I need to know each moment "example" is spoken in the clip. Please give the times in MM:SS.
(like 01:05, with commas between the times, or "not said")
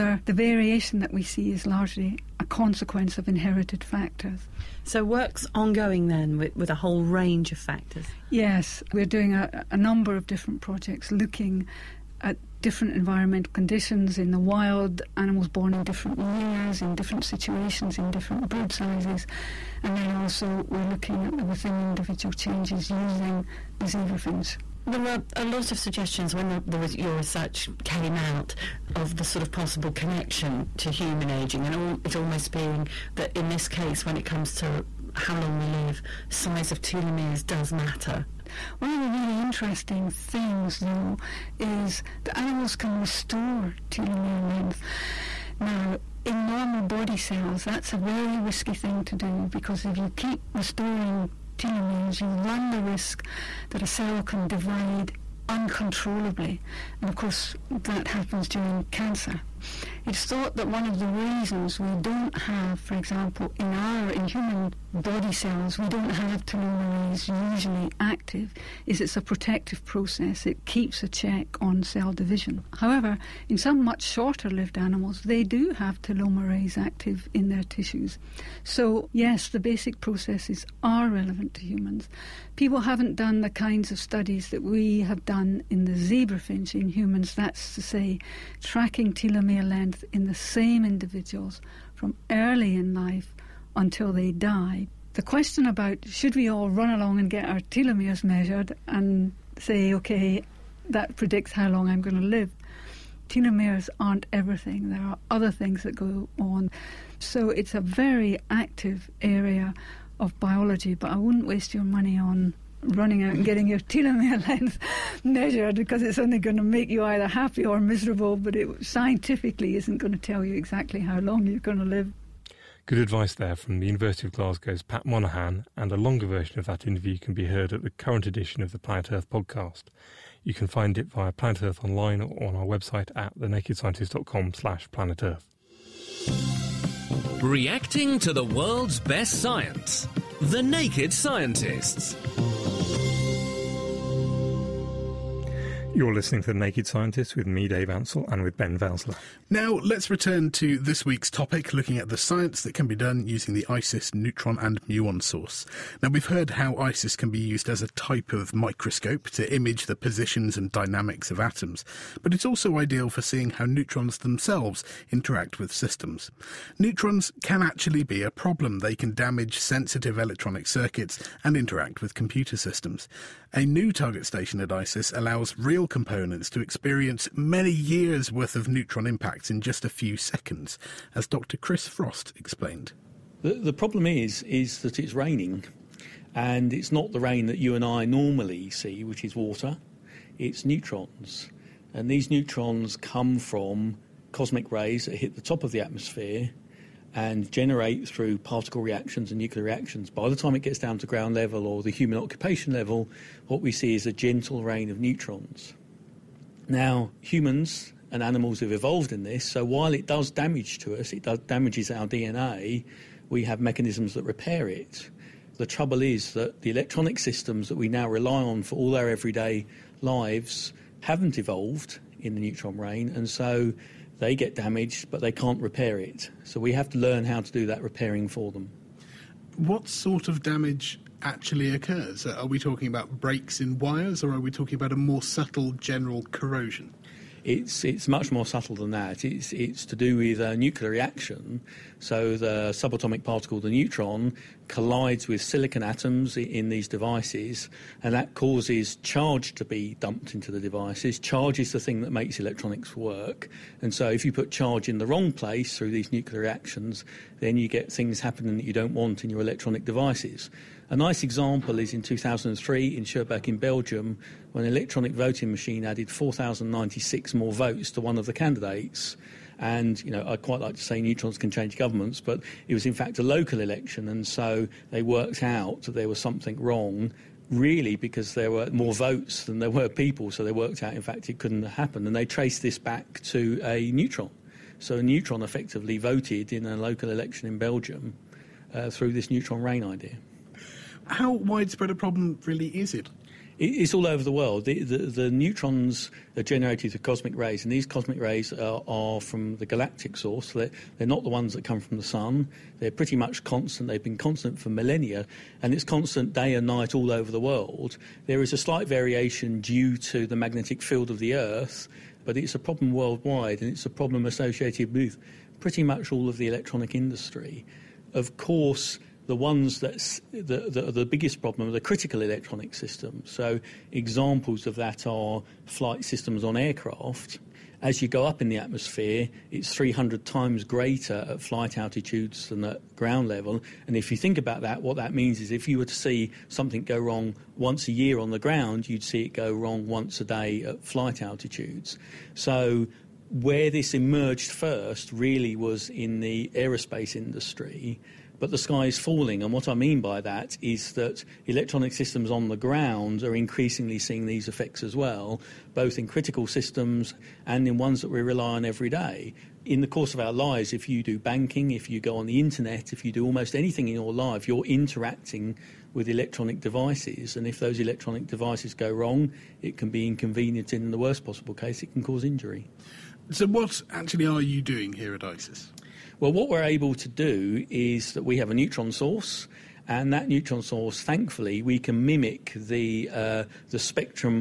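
01:02, 04:21, 05:23.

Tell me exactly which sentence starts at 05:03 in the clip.
They've been constant for millennia, and it's constant day and night all over the world.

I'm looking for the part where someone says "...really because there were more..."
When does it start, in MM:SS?
04:37.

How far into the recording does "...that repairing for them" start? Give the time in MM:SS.
03:47.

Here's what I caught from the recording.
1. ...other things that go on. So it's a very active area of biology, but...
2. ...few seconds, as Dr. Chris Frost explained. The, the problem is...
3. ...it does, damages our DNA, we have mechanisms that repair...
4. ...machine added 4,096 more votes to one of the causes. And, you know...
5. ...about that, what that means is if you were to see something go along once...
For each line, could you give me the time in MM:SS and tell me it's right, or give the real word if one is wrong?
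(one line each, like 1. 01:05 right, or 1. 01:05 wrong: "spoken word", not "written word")
1. 01:45 right
2. 02:59 right
3. 03:31 right
4. 04:25 wrong: "candidates", not "causes"
5. 05:34 wrong: "wrong", not "along".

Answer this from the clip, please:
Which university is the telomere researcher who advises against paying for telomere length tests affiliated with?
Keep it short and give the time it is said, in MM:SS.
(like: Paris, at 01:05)
University of Glasgow, at 02:03.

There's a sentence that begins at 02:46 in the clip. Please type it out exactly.
Neutrons can actually be a problem.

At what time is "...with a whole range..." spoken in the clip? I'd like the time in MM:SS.
00:06.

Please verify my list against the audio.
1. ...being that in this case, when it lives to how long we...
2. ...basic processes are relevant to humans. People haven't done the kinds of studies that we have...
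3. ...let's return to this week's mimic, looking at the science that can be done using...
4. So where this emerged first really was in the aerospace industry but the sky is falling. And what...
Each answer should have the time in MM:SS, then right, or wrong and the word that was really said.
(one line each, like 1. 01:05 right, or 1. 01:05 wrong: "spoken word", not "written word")
1. 00:32 wrong: "comes", not "lives"
2. 01:19 right
3. 02:29 wrong: "topic", not "mimic"
4. 05:42 right.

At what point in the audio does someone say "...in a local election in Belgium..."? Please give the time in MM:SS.
04:46.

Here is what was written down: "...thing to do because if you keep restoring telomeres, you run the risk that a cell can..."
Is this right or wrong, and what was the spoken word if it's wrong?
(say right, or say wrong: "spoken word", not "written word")
right.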